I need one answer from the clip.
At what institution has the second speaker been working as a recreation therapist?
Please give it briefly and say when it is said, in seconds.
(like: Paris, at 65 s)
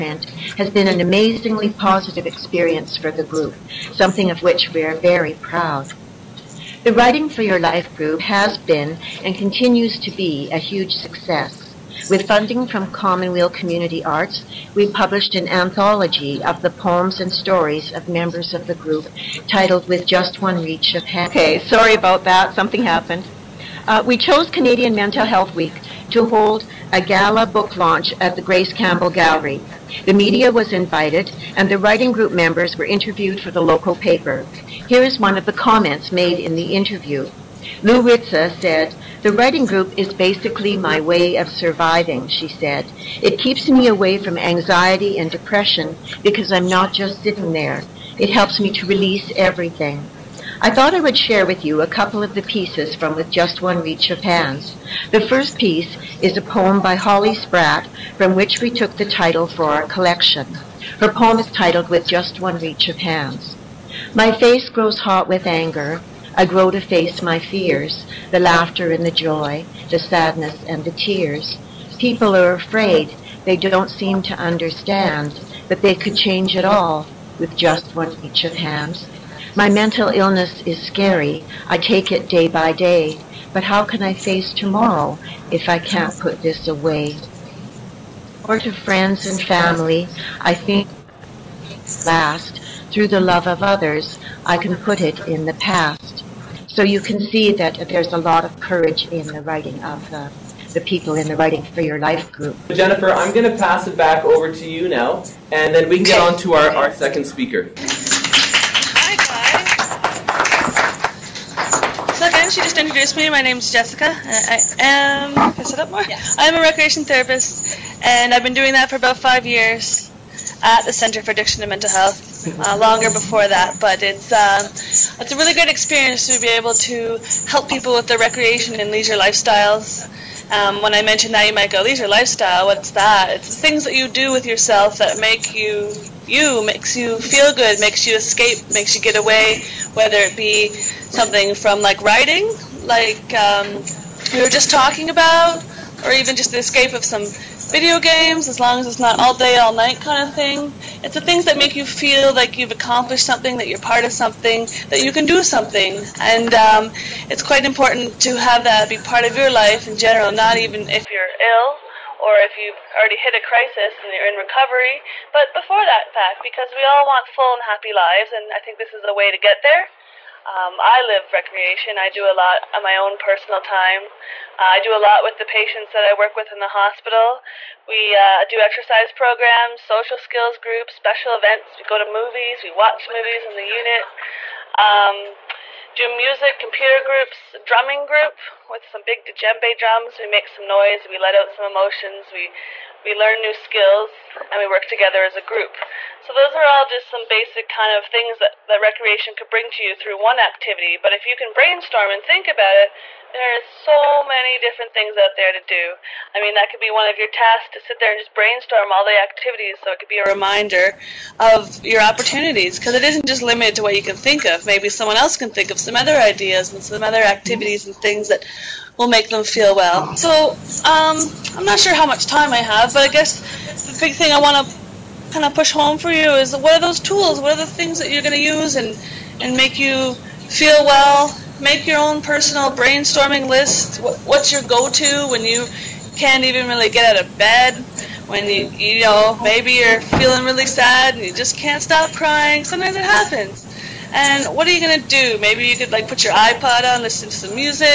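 Center for Addiction and Mental Health, at 120 s.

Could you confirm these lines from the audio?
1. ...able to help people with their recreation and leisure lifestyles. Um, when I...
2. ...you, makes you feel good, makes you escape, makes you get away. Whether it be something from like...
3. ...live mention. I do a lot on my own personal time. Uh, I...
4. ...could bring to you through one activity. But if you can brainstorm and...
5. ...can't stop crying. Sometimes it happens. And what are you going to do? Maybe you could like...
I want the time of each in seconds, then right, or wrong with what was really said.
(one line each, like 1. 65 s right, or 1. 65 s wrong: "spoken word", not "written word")
1. 126 s right
2. 136 s right
3. 171 s wrong: "recreation", not "mention"
4. 199 s right
5. 241 s right.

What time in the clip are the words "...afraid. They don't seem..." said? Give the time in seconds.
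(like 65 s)
72 s.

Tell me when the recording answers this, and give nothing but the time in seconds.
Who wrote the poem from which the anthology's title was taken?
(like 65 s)
56 s.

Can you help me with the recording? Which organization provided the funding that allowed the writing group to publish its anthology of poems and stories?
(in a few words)
Commonweal Community Arts.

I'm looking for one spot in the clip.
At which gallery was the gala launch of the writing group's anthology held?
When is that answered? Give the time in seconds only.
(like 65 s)
28 s.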